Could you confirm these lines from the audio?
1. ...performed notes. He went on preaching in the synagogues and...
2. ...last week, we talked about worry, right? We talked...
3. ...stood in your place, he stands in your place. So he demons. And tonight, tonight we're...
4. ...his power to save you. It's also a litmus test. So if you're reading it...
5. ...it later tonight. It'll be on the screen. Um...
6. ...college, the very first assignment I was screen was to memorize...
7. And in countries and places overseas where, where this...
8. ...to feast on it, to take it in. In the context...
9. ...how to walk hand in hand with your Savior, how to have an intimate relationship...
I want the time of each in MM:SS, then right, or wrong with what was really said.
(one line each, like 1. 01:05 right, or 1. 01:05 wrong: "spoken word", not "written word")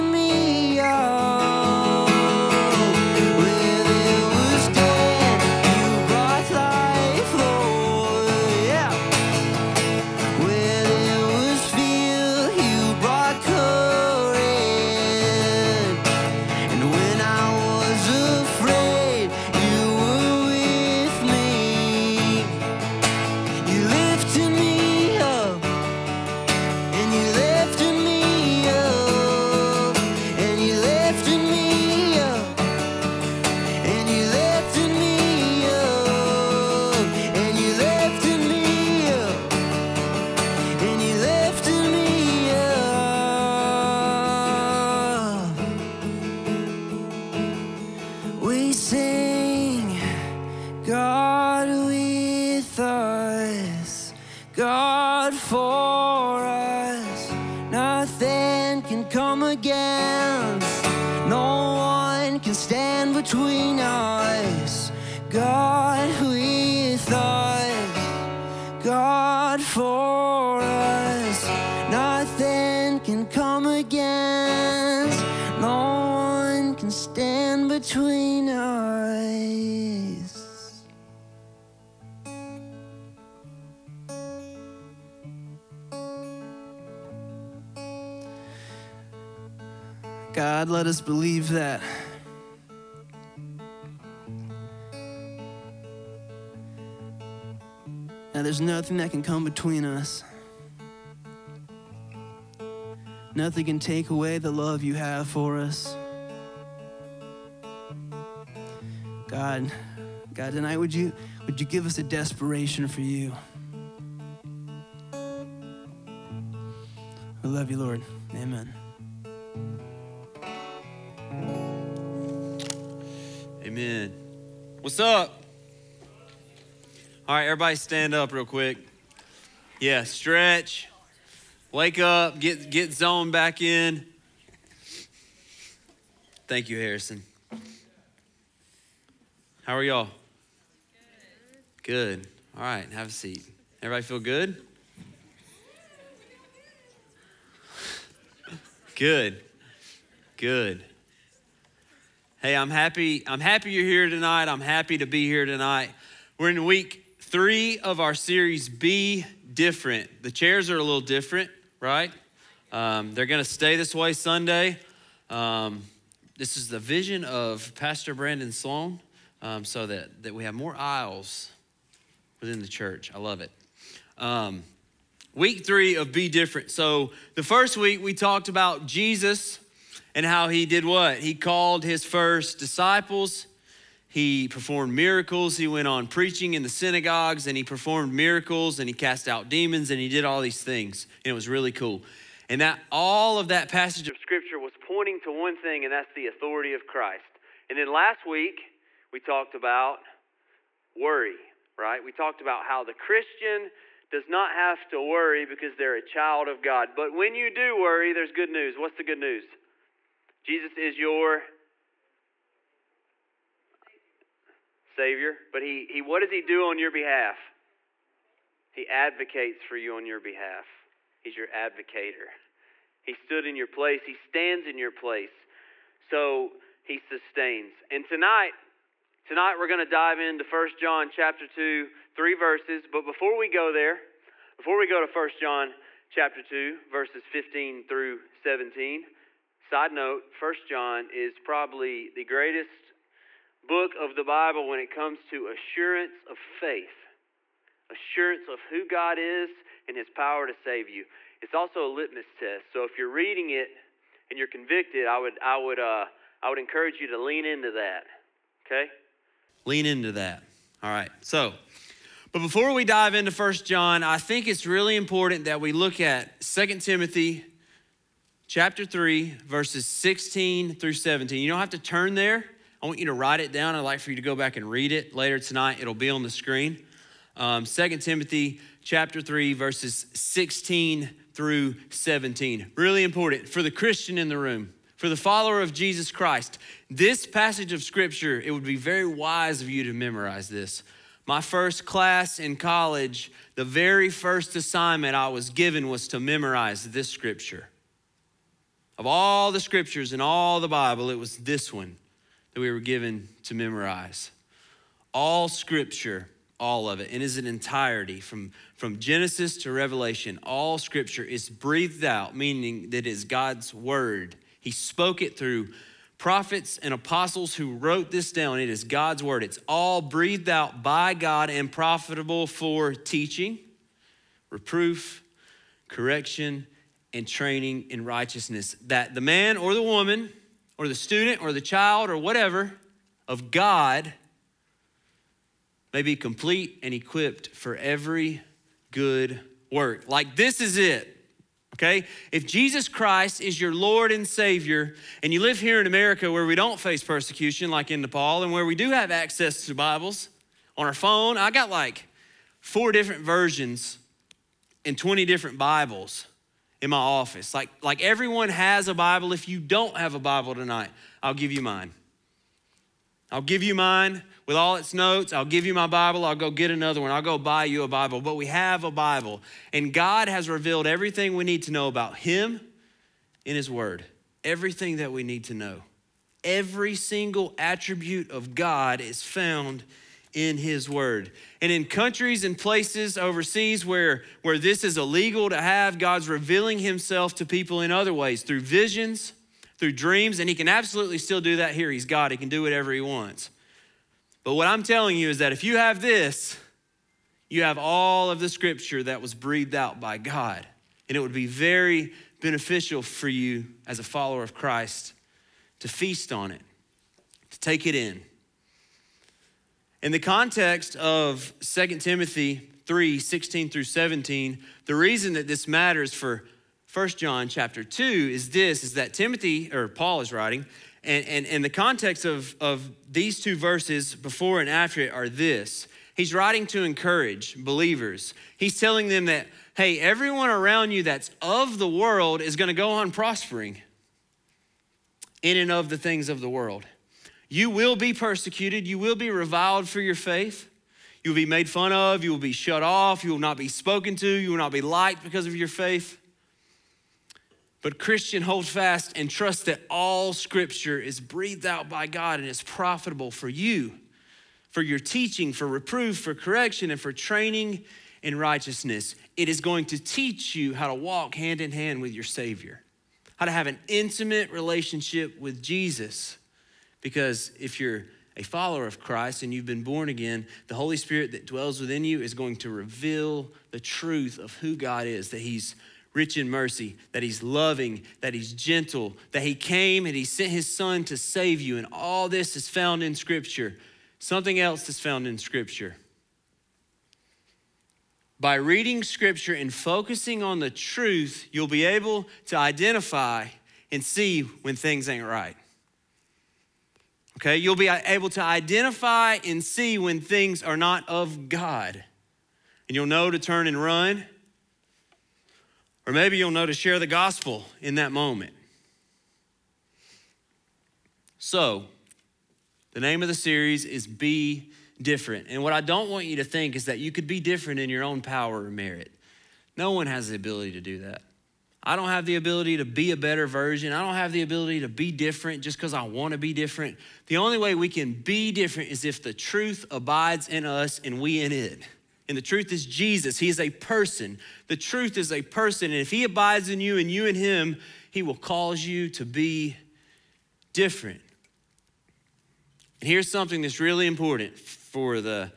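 1. 03:04 wrong: "miracles", not "notes"
2. 03:17 right
3. 03:43 wrong: "sustains", not "demons"
4. 04:09 right
5. 04:34 right
6. 04:52 wrong: "given", not "screen"
7. 06:21 right
8. 06:45 right
9. 07:40 right.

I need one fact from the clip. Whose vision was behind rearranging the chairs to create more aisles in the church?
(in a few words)
Pastor Brandon Sloan.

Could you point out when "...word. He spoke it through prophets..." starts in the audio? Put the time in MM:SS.
05:13.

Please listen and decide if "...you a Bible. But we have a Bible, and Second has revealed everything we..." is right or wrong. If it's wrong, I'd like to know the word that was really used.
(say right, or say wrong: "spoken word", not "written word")
wrong: "God", not "Second".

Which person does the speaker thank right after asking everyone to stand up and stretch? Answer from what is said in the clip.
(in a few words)
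Harrison.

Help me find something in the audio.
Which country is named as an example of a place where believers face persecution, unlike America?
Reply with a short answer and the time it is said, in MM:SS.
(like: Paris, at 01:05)
Nepal, at 05:48.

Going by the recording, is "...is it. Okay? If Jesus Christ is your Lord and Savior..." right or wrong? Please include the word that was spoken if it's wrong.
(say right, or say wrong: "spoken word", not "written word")
right.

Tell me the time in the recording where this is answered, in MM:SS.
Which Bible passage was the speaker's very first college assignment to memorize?
04:26.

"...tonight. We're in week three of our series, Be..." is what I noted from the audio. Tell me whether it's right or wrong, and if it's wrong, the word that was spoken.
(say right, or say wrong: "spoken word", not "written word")
right.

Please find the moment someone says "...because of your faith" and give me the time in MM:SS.
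07:25.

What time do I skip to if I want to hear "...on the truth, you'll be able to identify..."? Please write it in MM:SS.
08:10.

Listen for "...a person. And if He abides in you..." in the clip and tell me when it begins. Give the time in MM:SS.
08:55.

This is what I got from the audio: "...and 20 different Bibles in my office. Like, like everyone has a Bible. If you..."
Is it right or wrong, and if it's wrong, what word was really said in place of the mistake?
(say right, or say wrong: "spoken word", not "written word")
right.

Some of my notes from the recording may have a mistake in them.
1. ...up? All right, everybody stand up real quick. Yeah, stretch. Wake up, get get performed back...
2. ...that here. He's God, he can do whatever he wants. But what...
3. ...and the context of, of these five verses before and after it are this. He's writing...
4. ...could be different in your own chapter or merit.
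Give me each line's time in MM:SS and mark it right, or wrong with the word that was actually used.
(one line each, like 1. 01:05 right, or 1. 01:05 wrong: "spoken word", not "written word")
1. 02:04 wrong: "zoned", not "performed"
2. 06:31 right
3. 07:01 wrong: "two", not "five"
4. 08:37 wrong: "power", not "chapter".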